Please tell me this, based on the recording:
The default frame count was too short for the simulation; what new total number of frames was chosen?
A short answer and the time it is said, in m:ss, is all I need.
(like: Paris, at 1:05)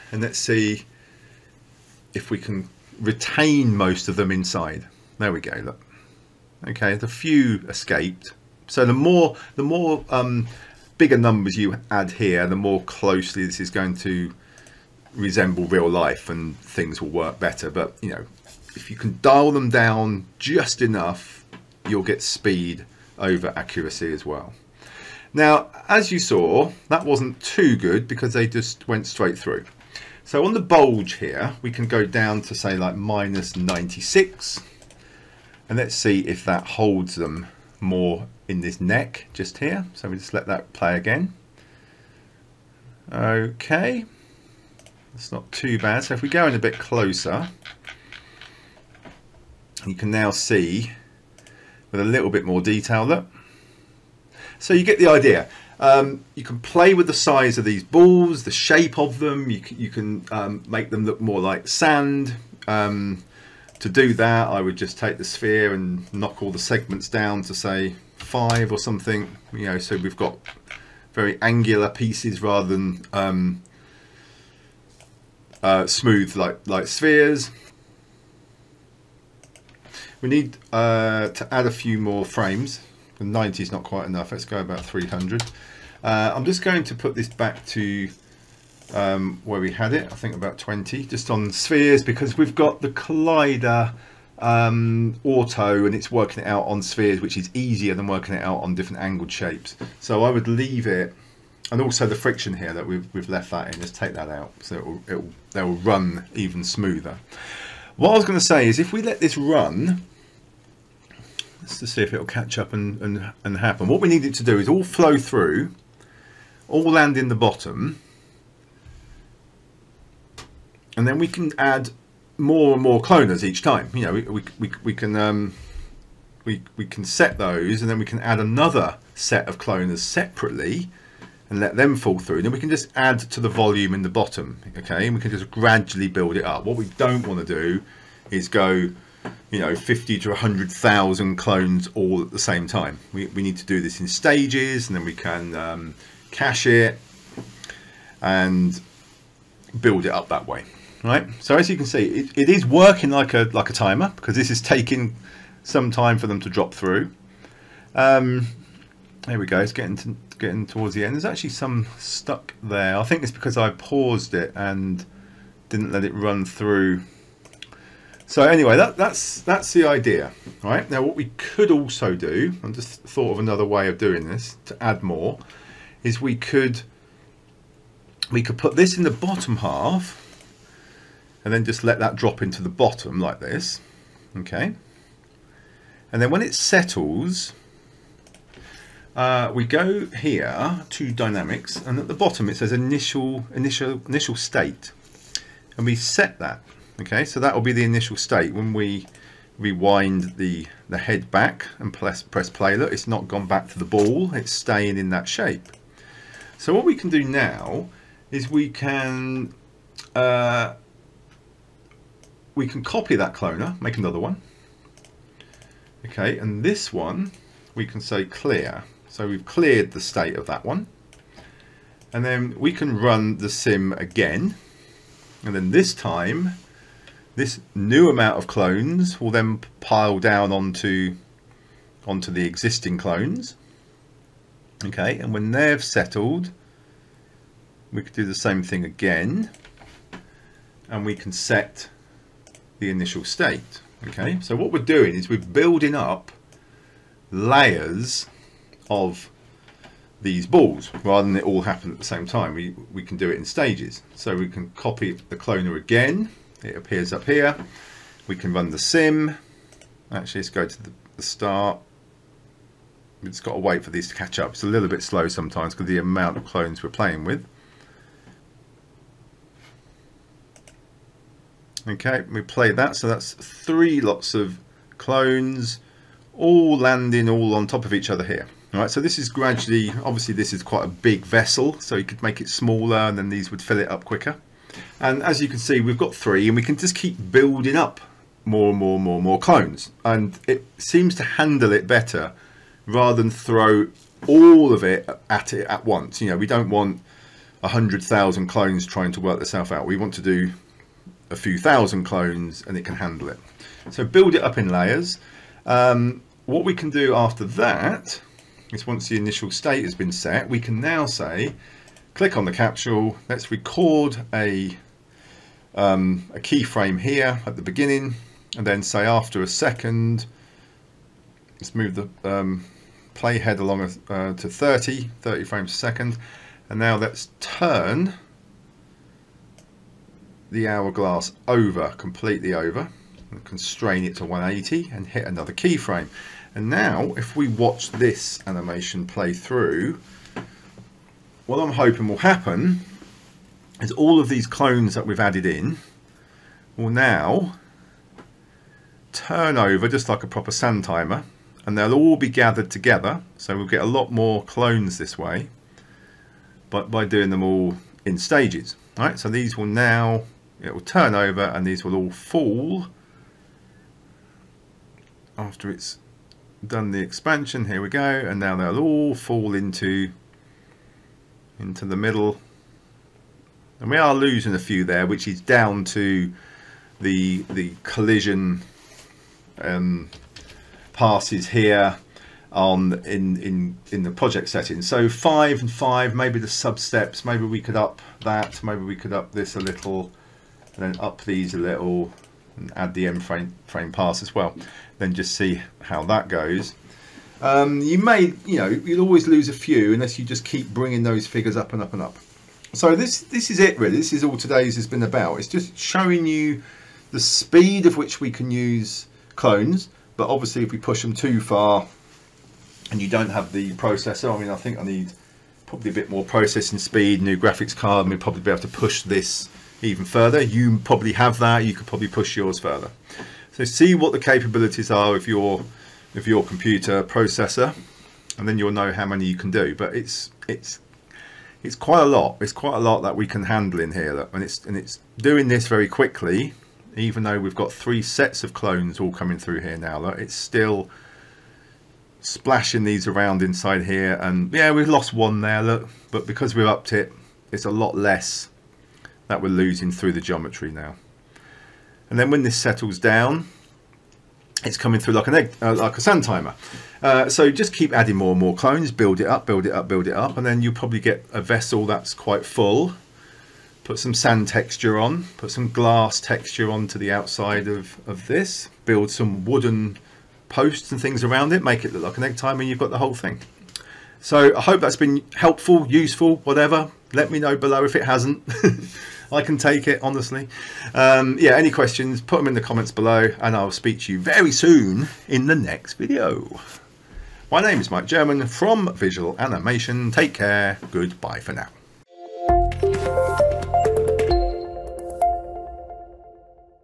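300, at 1:24.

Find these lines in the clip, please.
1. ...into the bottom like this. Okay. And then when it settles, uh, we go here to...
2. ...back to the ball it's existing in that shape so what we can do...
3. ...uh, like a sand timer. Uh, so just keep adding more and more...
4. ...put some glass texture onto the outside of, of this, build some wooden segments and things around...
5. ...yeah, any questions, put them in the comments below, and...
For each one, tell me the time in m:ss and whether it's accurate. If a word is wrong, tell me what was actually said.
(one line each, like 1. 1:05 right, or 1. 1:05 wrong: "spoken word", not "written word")
1. 3:02 right
2. 3:23 wrong: "staying", not "existing"
3. 7:35 right
4. 7:45 wrong: "posts", not "segments"
5. 8:01 right.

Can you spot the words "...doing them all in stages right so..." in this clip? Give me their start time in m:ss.
5:57.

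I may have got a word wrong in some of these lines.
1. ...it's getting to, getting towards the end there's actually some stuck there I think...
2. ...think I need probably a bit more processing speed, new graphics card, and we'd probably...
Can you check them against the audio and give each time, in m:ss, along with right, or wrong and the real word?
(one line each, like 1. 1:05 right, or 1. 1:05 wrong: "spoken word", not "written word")
1. 2:39 right
2. 6:54 right.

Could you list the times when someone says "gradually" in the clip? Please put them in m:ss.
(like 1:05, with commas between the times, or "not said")
2:15, 4:39.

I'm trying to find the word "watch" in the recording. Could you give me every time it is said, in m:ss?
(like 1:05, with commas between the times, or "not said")
5:37.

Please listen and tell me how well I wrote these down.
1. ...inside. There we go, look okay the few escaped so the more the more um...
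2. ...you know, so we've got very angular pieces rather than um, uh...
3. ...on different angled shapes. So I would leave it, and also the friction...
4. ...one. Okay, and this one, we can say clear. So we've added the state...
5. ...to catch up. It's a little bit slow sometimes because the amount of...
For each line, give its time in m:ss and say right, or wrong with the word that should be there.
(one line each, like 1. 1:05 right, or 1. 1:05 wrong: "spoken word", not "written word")
1. 0:04 right
2. 1:09 right
3. 1:38 right
4. 3:34 wrong: "cleared", not "added"
5. 4:24 right.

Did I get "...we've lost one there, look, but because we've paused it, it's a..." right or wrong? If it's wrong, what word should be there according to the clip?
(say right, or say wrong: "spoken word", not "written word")
wrong: "upped", not "paused".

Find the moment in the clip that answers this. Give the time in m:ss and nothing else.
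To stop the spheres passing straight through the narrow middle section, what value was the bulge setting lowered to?
0:32.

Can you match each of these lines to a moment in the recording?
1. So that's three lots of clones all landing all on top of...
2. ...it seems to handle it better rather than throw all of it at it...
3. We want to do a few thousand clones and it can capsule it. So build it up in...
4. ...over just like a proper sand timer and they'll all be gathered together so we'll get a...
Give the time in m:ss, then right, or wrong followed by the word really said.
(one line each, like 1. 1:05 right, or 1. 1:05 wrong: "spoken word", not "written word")
1. 4:32 right
2. 4:50 right
3. 4:59 wrong: "handle", not "capsule"
4. 5:49 right.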